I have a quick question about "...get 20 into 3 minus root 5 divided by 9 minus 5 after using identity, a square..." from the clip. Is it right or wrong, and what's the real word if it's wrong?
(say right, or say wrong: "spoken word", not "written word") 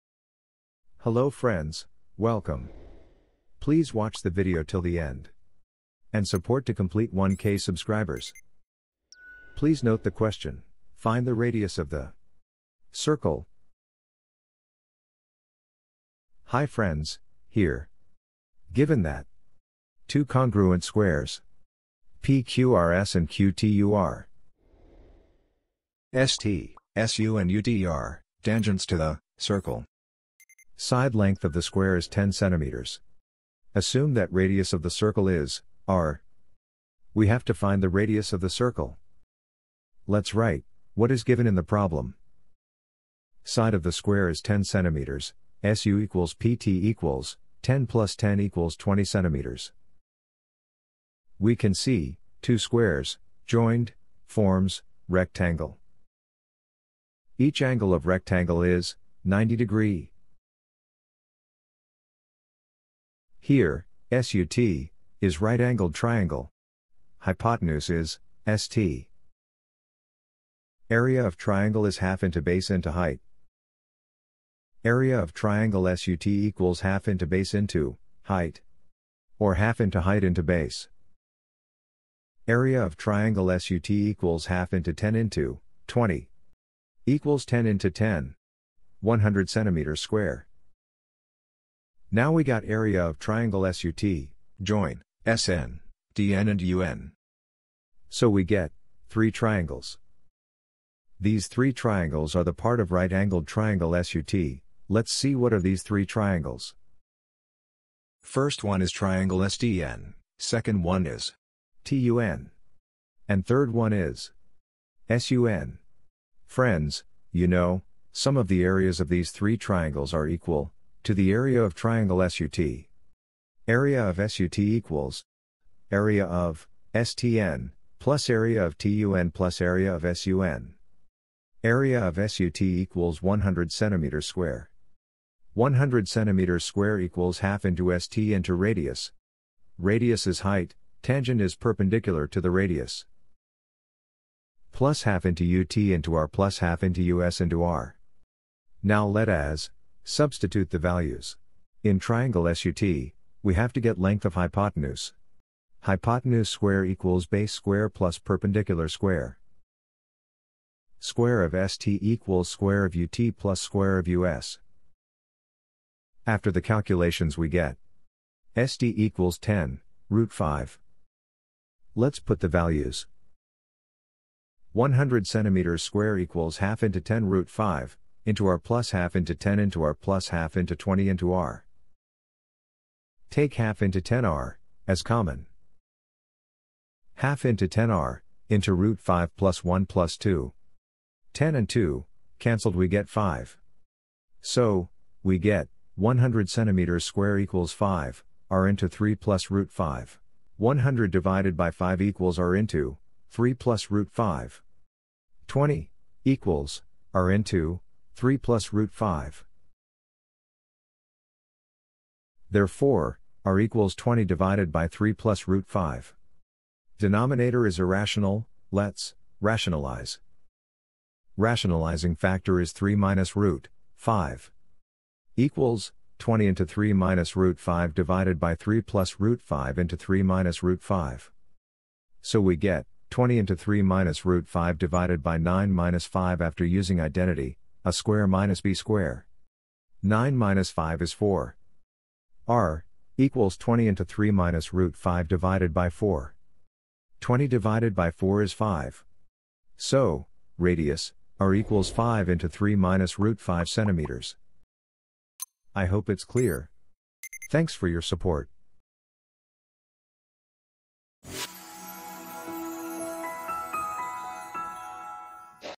right.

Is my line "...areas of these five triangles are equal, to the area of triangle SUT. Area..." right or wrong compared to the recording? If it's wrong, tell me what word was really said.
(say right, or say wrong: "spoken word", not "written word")
wrong: "three", not "five".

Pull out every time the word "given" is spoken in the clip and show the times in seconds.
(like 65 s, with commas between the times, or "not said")
18 s, 41 s.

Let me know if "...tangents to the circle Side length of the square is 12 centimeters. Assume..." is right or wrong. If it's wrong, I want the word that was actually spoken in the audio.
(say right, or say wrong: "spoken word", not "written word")
wrong: "10", not "12".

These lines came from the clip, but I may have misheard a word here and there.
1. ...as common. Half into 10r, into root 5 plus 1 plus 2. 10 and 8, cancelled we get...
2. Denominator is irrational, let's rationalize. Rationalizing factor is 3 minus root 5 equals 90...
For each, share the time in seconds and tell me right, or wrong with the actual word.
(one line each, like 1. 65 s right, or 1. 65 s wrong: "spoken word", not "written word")
1. 184 s wrong: "2", not "8"
2. 216 s wrong: "20", not "90".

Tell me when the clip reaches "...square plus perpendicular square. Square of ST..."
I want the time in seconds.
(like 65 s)
157 s.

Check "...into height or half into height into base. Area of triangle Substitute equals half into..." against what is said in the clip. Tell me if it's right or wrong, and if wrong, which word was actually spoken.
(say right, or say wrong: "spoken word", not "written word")
wrong: "SUT", not "Substitute".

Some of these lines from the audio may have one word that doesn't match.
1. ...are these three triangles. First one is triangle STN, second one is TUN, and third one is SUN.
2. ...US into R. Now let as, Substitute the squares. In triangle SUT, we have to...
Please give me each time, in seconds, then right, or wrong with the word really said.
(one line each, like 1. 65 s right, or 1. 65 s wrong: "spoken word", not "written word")
1. 105 s right
2. 147 s wrong: "values", not "squares".